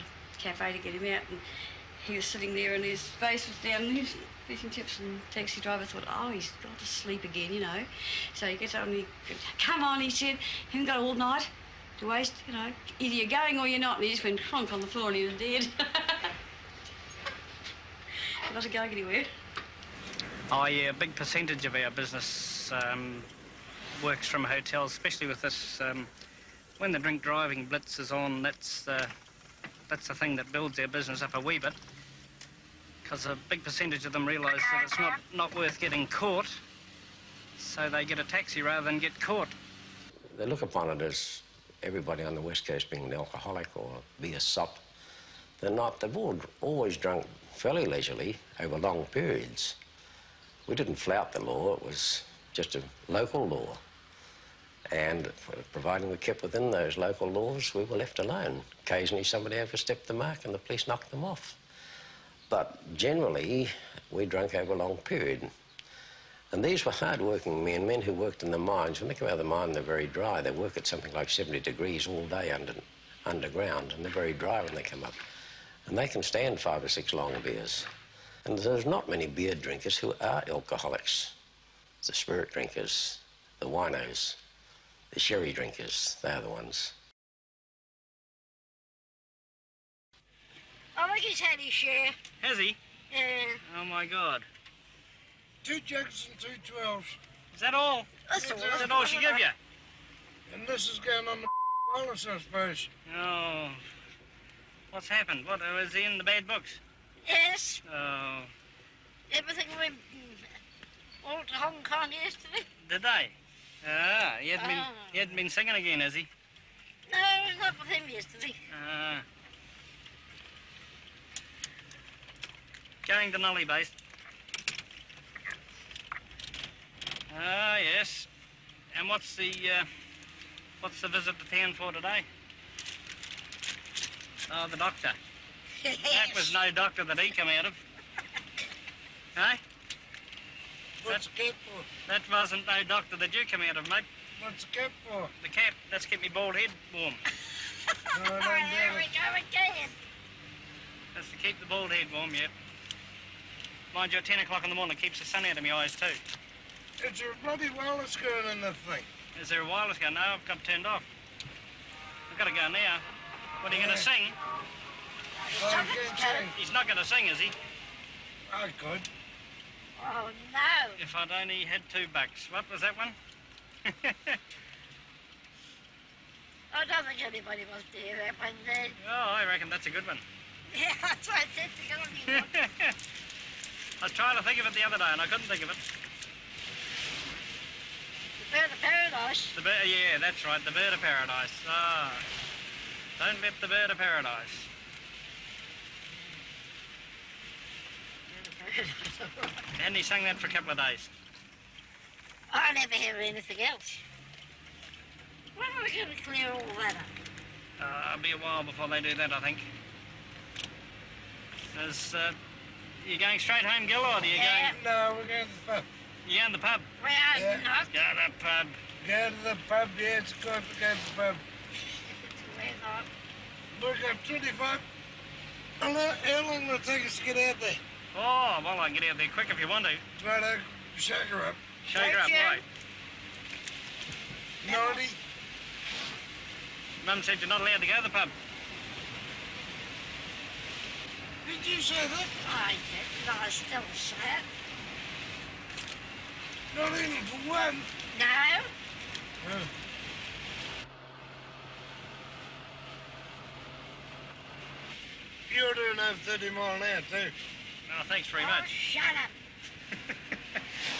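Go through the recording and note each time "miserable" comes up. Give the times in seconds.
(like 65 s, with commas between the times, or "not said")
not said.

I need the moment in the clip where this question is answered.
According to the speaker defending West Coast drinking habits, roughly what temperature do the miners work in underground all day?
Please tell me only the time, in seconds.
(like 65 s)
71 s.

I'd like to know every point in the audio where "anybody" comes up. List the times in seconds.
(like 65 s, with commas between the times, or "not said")
177 s.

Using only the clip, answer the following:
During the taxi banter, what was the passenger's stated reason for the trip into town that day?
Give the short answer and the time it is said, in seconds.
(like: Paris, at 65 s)
The doctor, at 134 s.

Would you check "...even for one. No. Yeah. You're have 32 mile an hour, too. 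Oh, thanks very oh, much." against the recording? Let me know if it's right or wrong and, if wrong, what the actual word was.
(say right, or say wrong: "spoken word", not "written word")
wrong: "30", not "32".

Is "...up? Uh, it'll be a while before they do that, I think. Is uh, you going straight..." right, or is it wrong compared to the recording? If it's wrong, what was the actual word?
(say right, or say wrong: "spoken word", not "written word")
right.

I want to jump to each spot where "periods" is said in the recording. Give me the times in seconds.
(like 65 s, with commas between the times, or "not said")
49 s, 64 s.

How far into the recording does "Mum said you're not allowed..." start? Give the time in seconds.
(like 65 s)
237 s.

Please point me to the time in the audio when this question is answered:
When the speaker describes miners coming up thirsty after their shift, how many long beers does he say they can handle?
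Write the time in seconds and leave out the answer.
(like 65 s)
76 s.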